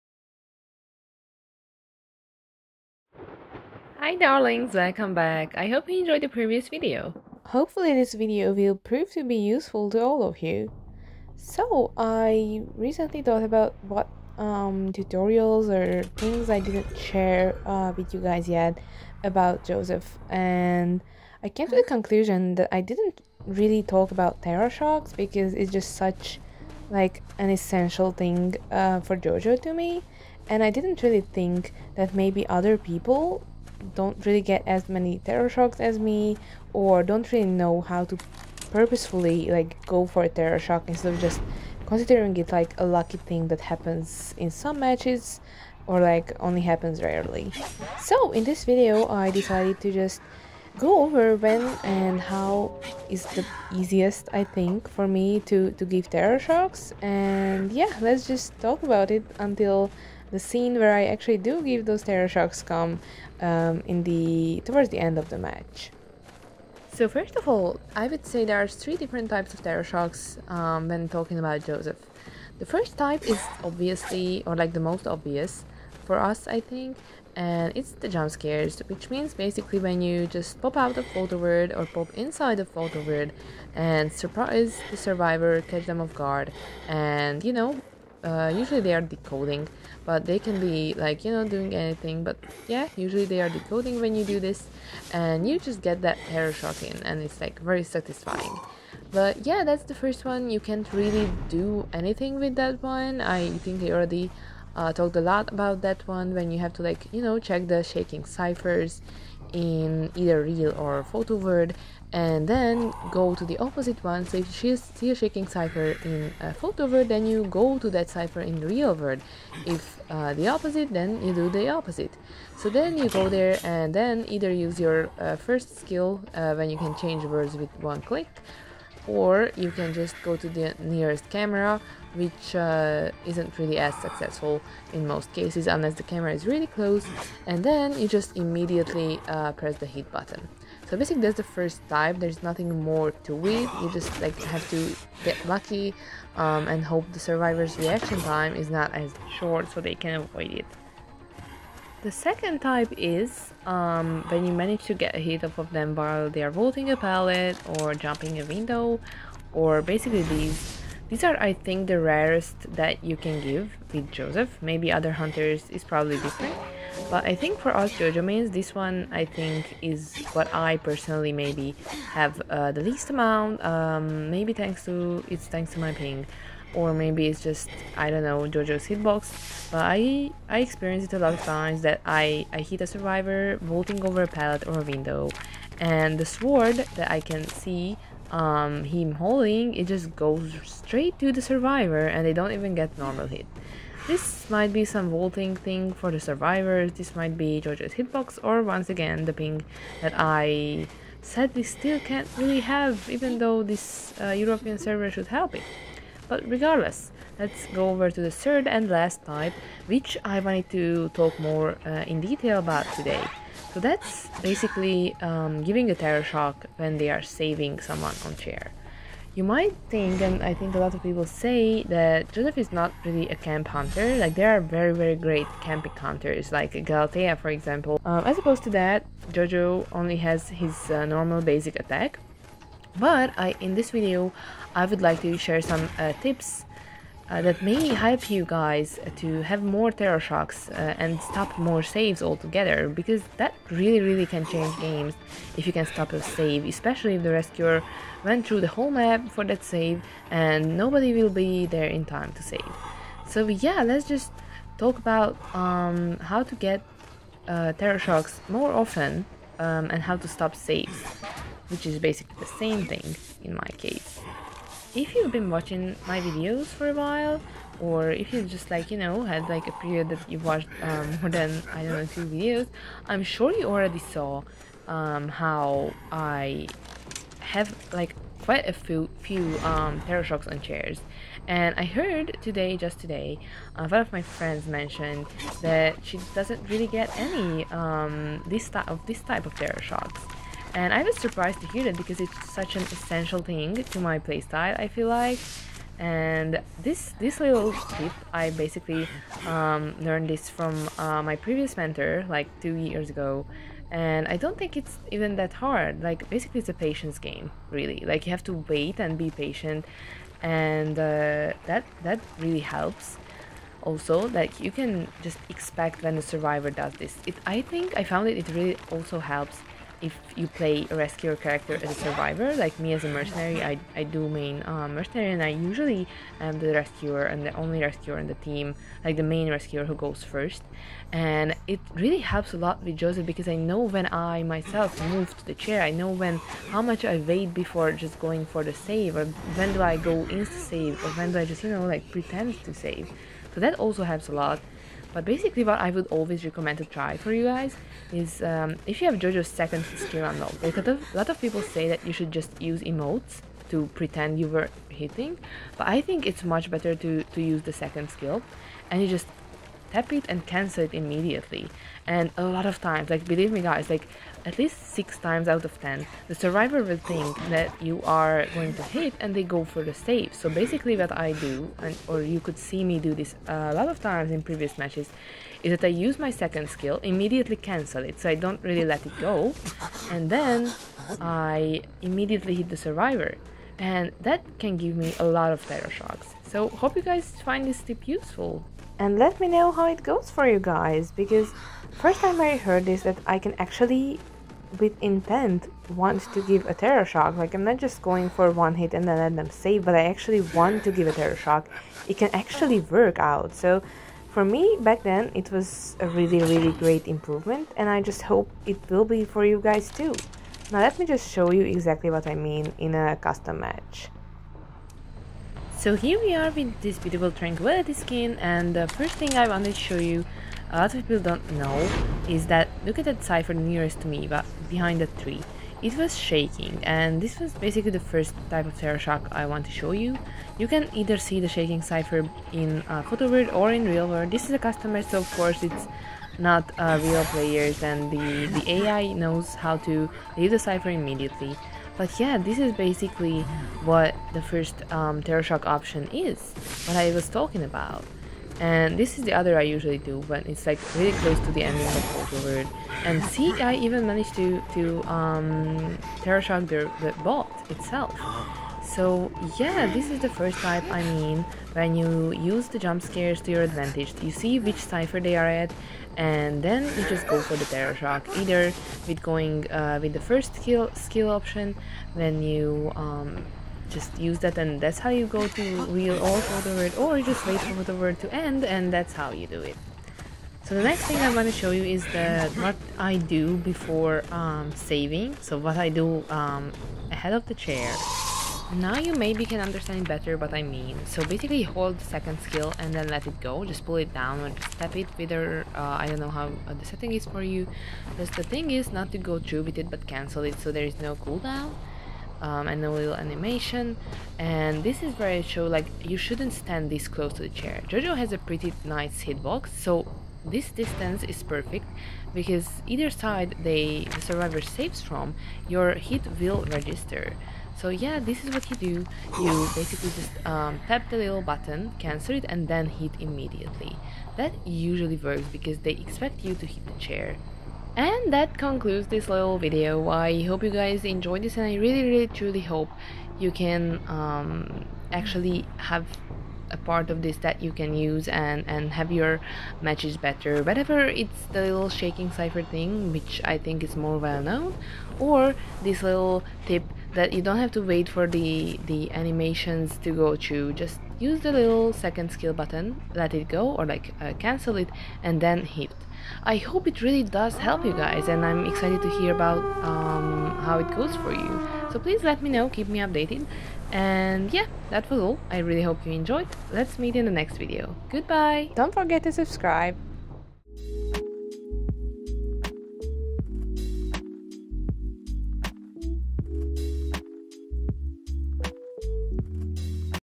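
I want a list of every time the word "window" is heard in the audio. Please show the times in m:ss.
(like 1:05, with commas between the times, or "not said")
2:38, 3:04.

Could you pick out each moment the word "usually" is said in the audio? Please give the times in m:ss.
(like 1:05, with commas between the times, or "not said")
1:28, 1:32, 5:25, 7:29, 8:44.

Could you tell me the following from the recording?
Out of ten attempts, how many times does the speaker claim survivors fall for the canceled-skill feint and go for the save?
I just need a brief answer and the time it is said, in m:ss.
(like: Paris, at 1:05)
6, at 6:04.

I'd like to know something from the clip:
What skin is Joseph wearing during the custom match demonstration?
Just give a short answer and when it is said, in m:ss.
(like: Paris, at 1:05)
Tranquility, at 6:57.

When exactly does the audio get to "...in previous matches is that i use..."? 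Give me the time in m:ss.
6:14.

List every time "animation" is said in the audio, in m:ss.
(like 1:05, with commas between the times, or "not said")
8:23, 9:09.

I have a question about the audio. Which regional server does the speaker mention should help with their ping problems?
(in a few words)
European.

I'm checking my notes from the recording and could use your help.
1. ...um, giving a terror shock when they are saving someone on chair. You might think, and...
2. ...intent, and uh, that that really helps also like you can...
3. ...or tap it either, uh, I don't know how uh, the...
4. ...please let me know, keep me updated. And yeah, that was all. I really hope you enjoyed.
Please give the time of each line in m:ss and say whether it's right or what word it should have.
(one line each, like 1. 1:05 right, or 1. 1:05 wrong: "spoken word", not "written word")
1. 3:35 right
2. 5:09 wrong: "patient", not "intent"
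3. 8:14 wrong: "whether", not "either"
4. 9:21 right.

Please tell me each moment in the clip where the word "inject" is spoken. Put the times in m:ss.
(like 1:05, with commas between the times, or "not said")
not said.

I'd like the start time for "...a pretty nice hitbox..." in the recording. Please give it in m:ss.
8:28.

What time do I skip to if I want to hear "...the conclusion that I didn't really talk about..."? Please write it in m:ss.
0:21.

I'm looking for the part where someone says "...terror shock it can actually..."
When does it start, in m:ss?
6:41.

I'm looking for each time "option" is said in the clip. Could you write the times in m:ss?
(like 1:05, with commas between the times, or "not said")
7:25, 7:51.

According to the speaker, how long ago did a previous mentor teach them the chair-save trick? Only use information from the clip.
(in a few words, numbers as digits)
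2 years ago.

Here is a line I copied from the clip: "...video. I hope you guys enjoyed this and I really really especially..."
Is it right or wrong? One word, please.
wrong.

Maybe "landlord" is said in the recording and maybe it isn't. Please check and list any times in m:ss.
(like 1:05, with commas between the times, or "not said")
not said.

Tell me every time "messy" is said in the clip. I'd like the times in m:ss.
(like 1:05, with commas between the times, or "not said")
not said.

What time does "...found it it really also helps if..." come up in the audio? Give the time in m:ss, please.
5:18.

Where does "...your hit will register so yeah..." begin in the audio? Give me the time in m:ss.
8:35.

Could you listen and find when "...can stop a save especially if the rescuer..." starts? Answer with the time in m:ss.
4:05.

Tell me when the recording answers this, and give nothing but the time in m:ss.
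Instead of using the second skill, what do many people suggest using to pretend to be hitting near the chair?
5:52.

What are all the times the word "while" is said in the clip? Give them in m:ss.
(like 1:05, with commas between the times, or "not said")
2:35, 4:26.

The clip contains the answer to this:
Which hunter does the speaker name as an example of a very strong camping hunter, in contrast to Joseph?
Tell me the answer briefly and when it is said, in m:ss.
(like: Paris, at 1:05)
Galatea, at 3:46.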